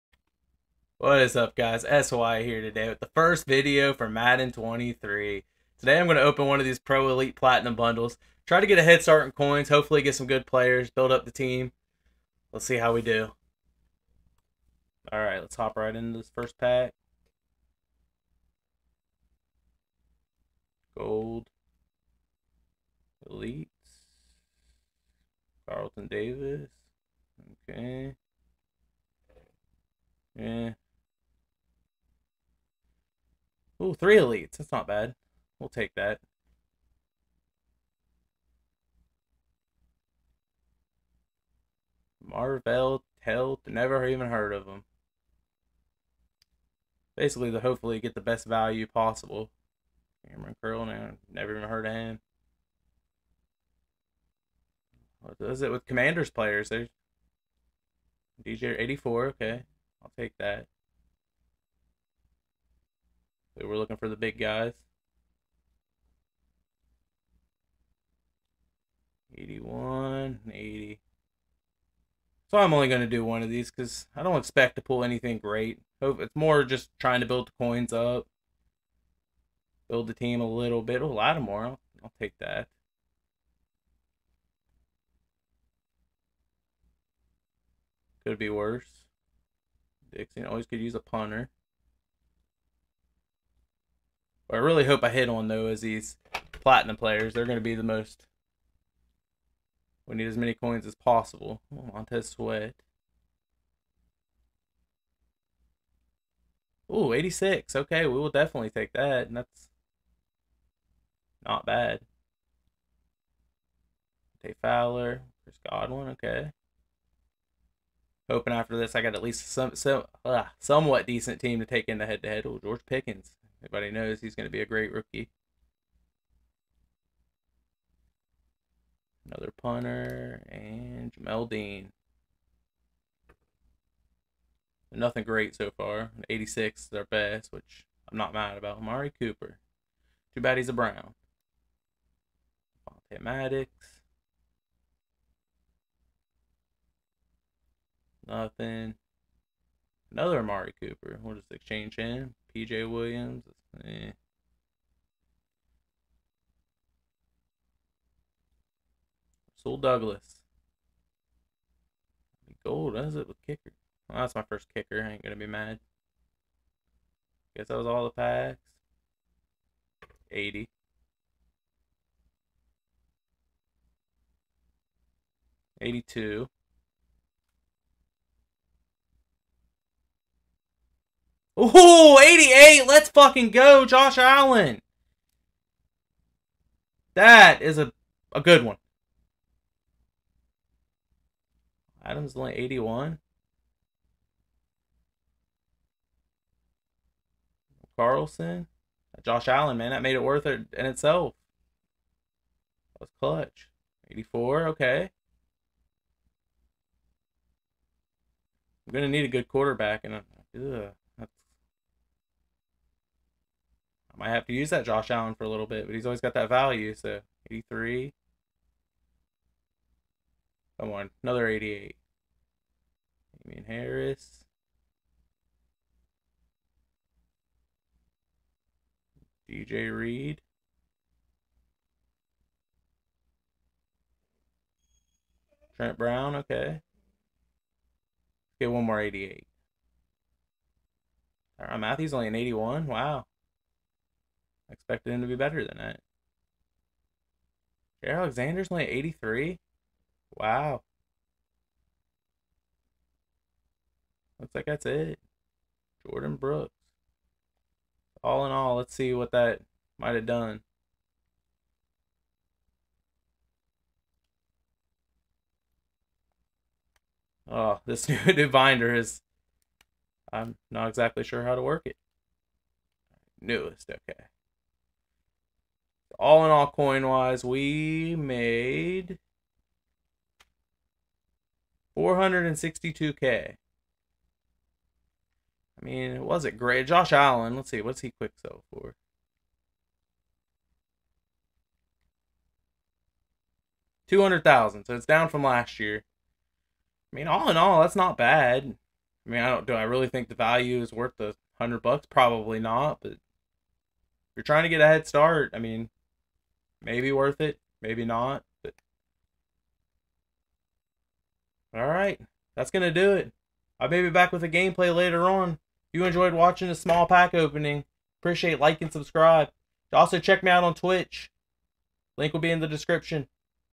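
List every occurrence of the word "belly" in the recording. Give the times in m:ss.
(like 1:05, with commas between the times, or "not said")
not said.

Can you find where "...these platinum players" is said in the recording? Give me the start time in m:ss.
1:35.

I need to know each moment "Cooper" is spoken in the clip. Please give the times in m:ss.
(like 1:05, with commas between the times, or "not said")
2:19, 2:30.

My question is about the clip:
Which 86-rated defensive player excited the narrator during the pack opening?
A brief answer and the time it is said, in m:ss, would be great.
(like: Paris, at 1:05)
Montez Sweat, at 1:41.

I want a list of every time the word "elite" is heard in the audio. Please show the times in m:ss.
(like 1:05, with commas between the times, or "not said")
0:07, 0:23, 0:34.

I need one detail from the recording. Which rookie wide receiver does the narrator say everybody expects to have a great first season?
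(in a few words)
George Pickens.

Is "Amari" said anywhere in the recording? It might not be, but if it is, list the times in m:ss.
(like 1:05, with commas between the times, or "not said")
2:18, 2:30.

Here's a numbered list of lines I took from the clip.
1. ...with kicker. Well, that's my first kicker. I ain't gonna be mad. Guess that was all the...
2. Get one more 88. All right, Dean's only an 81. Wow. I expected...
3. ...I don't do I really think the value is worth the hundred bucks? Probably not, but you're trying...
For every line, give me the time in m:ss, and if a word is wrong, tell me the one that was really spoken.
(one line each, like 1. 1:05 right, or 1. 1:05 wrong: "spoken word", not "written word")
1. 2:43 right
2. 3:58 wrong: "Matthew", not "Dean"
3. 4:59 right.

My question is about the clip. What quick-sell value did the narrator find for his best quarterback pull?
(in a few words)
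200,000.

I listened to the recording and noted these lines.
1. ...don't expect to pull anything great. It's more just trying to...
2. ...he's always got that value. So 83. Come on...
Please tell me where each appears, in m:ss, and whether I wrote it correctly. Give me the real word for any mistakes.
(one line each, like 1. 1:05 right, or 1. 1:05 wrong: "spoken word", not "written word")
1. 1:14 right
2. 3:35 right.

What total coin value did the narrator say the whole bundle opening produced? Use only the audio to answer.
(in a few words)
462k.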